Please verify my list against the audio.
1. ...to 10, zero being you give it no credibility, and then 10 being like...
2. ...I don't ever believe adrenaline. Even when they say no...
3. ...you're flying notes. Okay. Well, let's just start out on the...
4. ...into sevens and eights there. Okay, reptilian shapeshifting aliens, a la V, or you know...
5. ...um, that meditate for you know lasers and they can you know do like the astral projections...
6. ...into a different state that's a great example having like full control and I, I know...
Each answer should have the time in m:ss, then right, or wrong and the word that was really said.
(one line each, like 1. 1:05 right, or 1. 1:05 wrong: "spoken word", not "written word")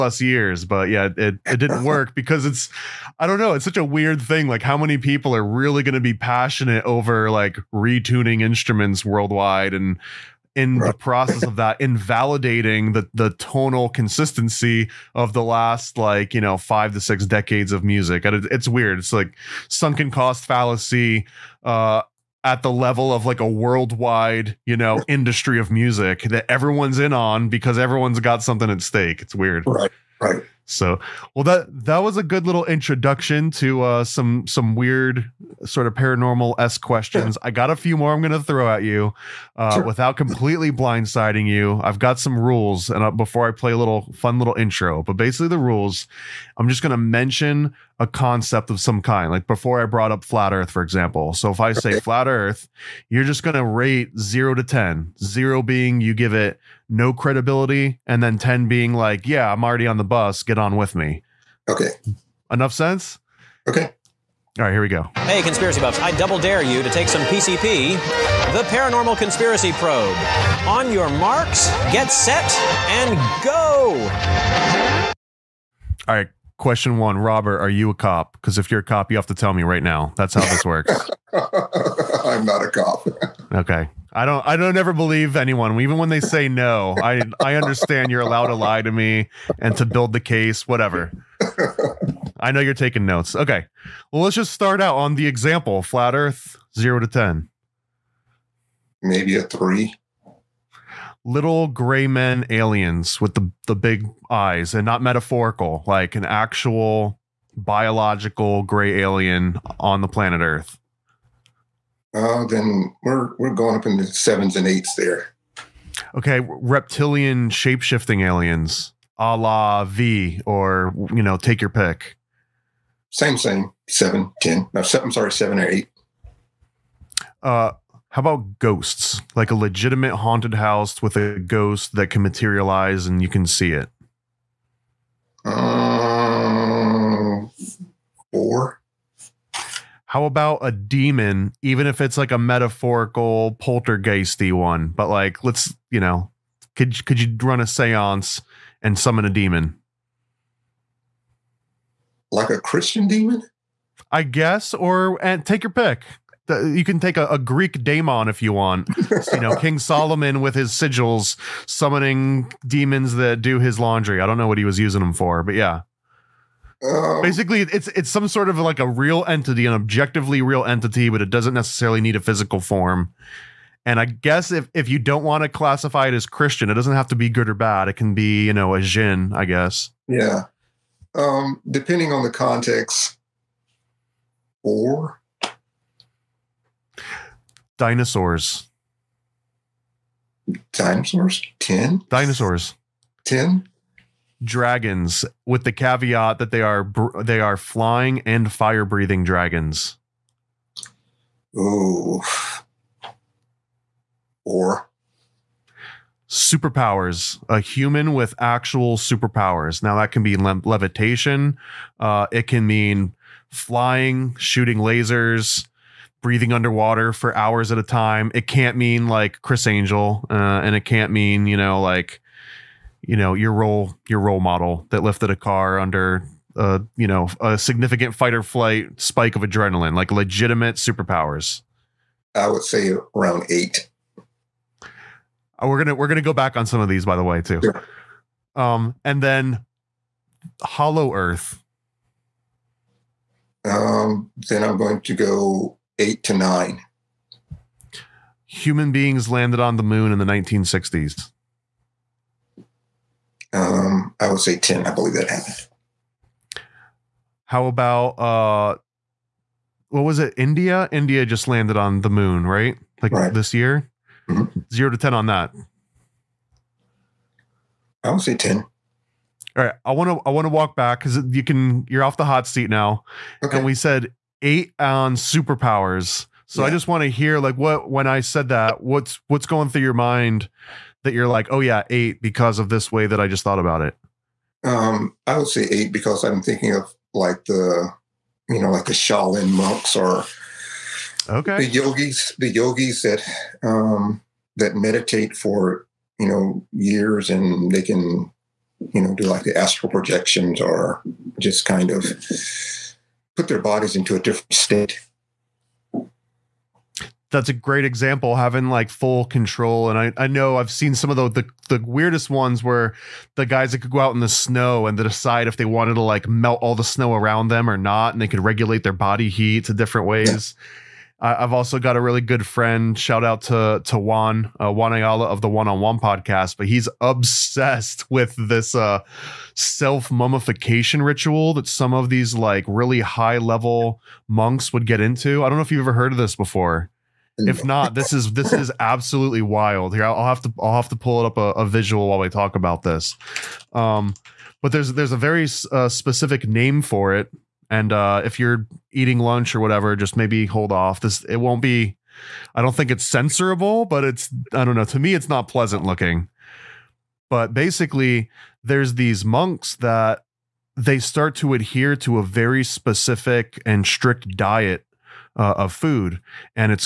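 1. 0:54 right
2. 1:24 wrong: "anyone", not "adrenaline"
3. 1:32 wrong: "taking", not "flying"
4. 1:53 right
5. 4:53 wrong: "years", not "lasers"
6. 5:03 right.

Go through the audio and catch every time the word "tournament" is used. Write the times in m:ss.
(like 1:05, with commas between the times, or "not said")
not said.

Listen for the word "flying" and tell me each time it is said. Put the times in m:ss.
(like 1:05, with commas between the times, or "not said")
3:17, 3:33.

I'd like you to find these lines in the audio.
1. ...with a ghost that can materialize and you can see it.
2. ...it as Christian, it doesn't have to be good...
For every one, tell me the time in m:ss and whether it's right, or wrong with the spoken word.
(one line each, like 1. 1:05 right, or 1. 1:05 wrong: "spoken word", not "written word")
1. 2:11 right
2. 2:56 right.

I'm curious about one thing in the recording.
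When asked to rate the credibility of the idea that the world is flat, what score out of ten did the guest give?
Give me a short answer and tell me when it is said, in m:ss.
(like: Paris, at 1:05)
3, at 1:39.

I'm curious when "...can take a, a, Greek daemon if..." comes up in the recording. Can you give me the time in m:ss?
2:36.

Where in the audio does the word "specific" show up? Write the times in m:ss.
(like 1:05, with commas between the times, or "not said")
5:45, 6:02.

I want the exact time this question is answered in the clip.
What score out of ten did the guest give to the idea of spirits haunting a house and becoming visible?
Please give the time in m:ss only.
2:18.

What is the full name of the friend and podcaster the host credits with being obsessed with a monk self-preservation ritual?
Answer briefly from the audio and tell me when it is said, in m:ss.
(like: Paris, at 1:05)
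Juan Ayala, at 5:24.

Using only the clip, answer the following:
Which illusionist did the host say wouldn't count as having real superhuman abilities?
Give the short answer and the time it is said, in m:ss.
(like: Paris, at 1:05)
Criss Angel, at 3:39.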